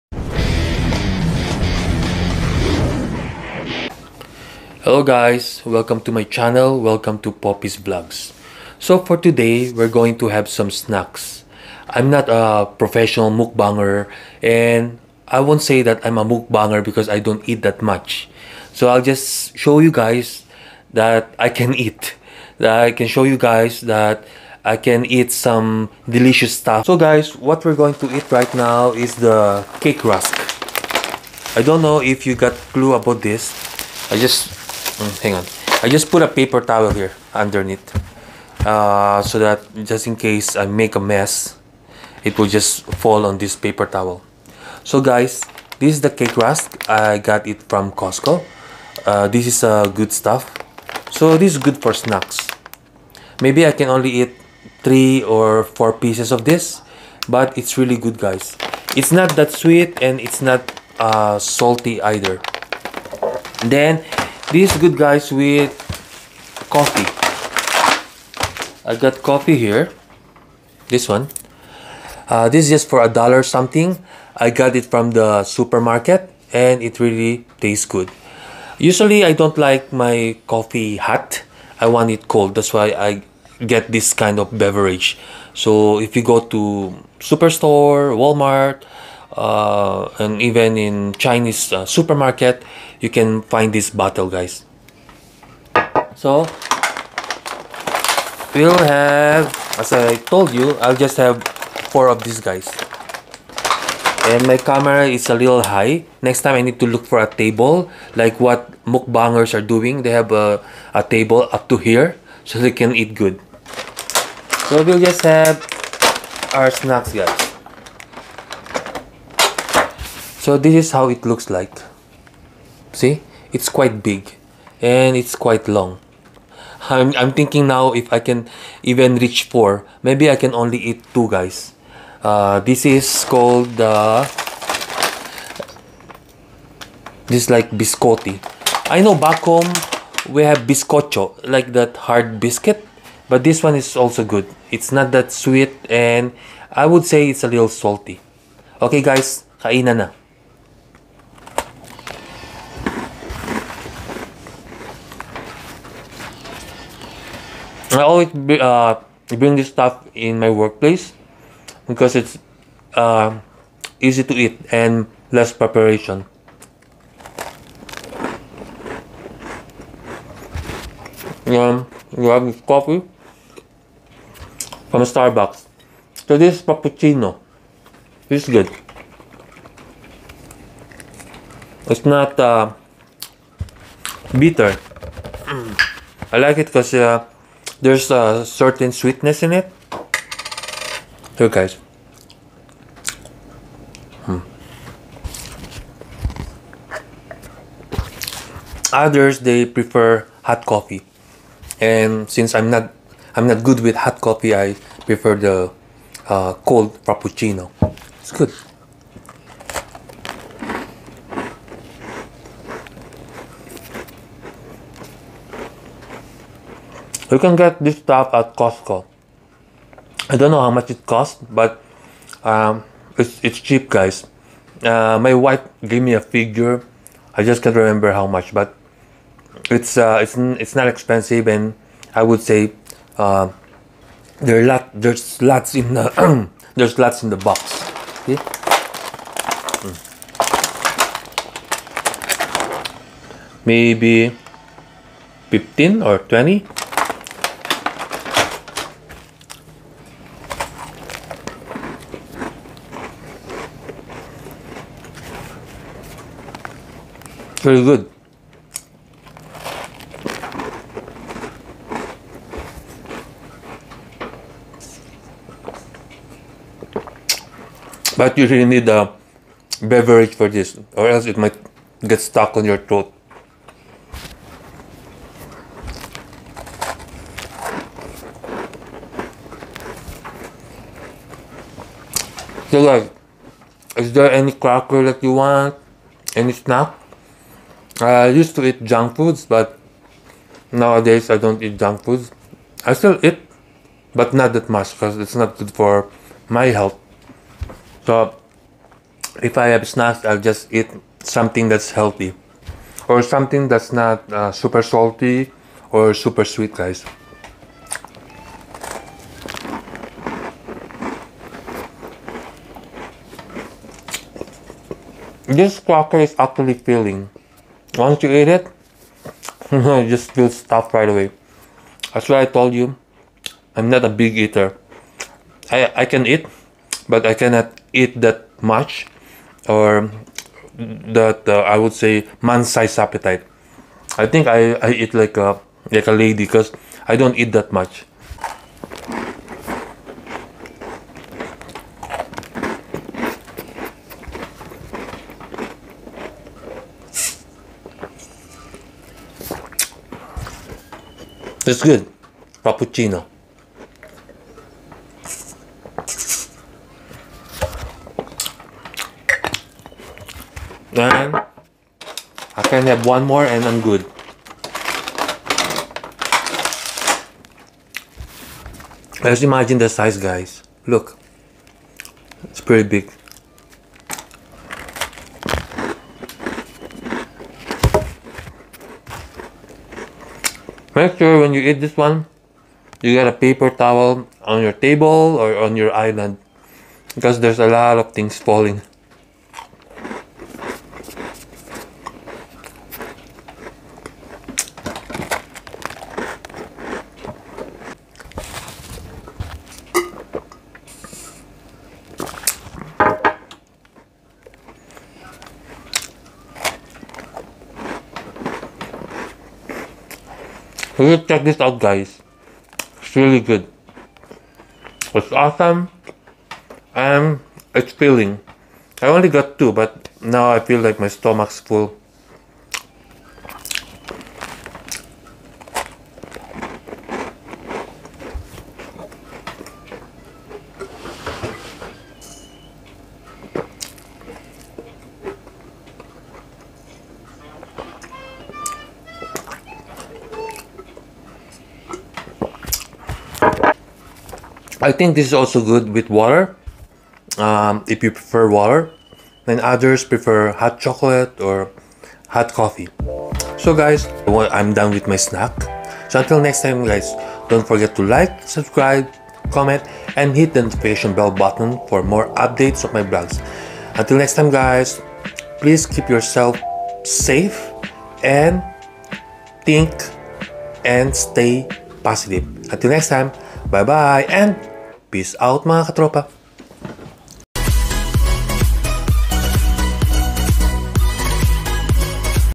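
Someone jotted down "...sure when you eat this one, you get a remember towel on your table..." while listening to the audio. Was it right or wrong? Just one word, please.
wrong.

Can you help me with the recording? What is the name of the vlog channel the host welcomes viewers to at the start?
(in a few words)
Popi's Vlogs.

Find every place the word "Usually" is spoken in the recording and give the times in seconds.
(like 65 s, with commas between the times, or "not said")
78 s.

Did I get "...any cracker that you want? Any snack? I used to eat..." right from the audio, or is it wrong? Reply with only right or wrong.
right.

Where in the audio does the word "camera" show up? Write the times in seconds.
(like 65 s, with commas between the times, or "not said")
104 s.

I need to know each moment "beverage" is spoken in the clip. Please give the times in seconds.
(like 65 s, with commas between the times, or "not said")
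84 s, 269 s.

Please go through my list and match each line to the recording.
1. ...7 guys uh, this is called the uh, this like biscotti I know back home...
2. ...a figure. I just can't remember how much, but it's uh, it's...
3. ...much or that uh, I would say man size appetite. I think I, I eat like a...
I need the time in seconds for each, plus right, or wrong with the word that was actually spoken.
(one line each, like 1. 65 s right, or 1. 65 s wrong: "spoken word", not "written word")
1. 131 s wrong: "2", not "7"
2. 226 s right
3. 328 s right.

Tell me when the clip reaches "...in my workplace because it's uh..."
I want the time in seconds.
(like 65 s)
160 s.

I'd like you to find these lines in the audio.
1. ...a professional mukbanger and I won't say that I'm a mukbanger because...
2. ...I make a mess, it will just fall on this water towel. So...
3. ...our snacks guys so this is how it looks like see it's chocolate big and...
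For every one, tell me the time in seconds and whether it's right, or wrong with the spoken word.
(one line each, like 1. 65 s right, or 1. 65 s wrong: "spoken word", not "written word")
1. 12 s right
2. 40 s wrong: "paper", not "water"
3. 116 s wrong: "quite", not "chocolate".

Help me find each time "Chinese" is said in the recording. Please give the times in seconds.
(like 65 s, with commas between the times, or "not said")
91 s.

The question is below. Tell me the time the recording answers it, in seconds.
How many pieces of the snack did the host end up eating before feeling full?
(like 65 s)
419 s.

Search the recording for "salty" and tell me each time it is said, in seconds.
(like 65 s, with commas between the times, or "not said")
61 s, 147 s, 304 s.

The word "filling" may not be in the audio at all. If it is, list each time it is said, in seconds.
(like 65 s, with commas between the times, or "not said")
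316 s, 417 s.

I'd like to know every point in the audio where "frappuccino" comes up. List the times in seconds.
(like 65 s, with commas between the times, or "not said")
207 s, 352 s.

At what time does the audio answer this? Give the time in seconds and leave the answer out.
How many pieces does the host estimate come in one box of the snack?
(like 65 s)
245 s.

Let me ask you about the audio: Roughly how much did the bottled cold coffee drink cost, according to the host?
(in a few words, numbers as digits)
A dollar something.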